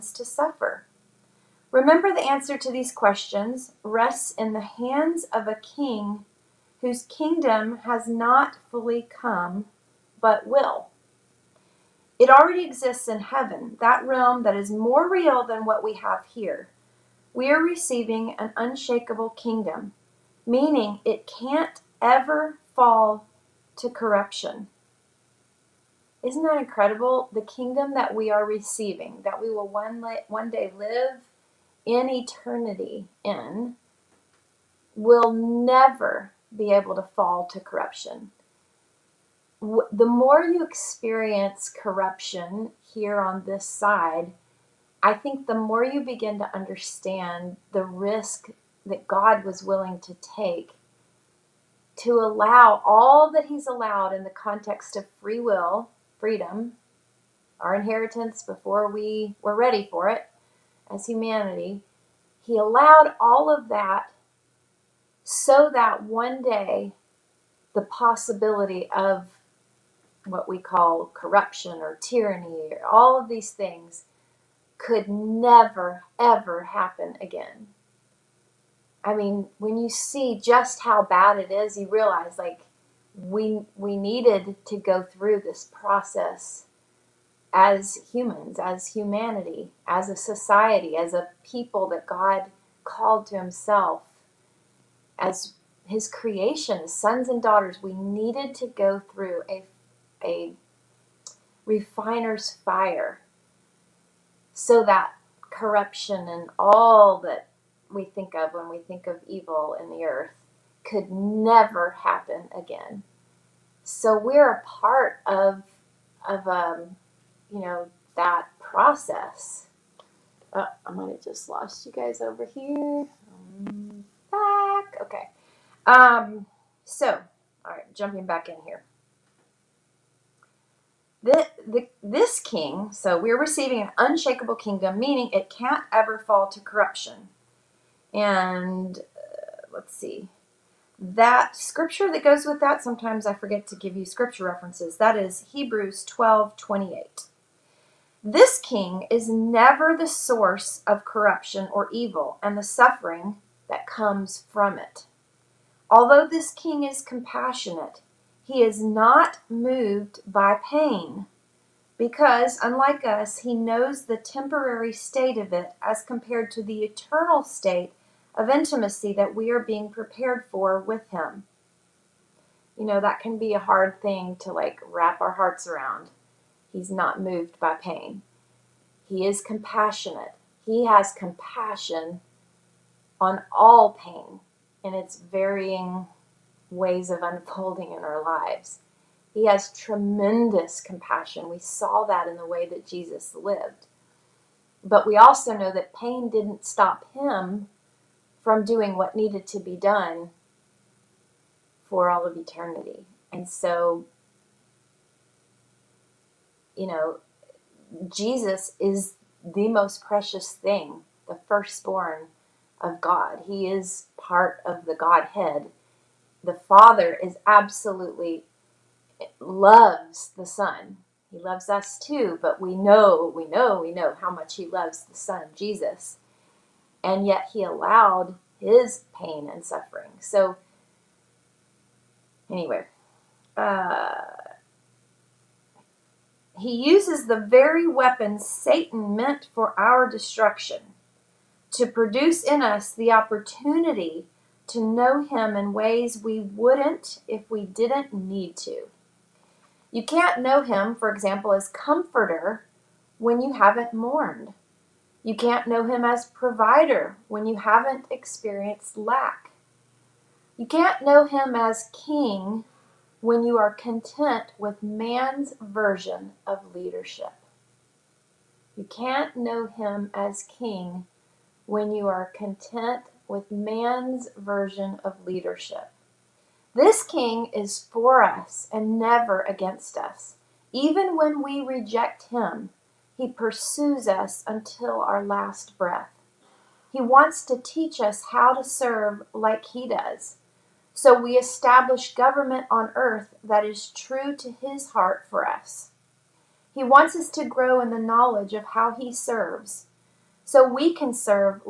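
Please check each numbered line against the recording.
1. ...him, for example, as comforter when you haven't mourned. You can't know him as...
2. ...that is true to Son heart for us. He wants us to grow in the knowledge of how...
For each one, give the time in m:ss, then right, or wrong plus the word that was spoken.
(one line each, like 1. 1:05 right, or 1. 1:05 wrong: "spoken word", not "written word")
1. 4:10 right
2. 4:53 wrong: "His", not "Son".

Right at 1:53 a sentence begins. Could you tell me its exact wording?
So we're a part of, of um, you know, that process.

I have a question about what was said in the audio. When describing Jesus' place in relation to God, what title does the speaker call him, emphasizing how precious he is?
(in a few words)
the firstborn of God.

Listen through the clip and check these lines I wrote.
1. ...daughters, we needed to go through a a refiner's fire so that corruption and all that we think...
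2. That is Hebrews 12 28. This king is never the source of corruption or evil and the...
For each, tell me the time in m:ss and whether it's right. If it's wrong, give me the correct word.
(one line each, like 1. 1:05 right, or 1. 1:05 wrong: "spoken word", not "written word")
1. 1:37 right
2. 2:24 right.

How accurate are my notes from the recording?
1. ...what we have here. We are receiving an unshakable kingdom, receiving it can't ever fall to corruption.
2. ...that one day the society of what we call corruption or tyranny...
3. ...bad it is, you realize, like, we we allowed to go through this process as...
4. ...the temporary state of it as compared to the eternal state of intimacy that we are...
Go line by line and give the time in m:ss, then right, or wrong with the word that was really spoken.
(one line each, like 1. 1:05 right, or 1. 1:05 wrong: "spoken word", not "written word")
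1. 0:15 wrong: "meaning", not "receiving"
2. 1:05 wrong: "possibility", not "society"
3. 1:21 wrong: "needed", not "allowed"
4. 2:44 right.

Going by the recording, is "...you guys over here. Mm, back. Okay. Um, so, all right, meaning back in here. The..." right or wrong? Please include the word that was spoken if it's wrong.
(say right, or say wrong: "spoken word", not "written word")
wrong: "jumping", not "meaning".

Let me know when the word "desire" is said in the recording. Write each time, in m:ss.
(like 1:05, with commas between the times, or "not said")
not said.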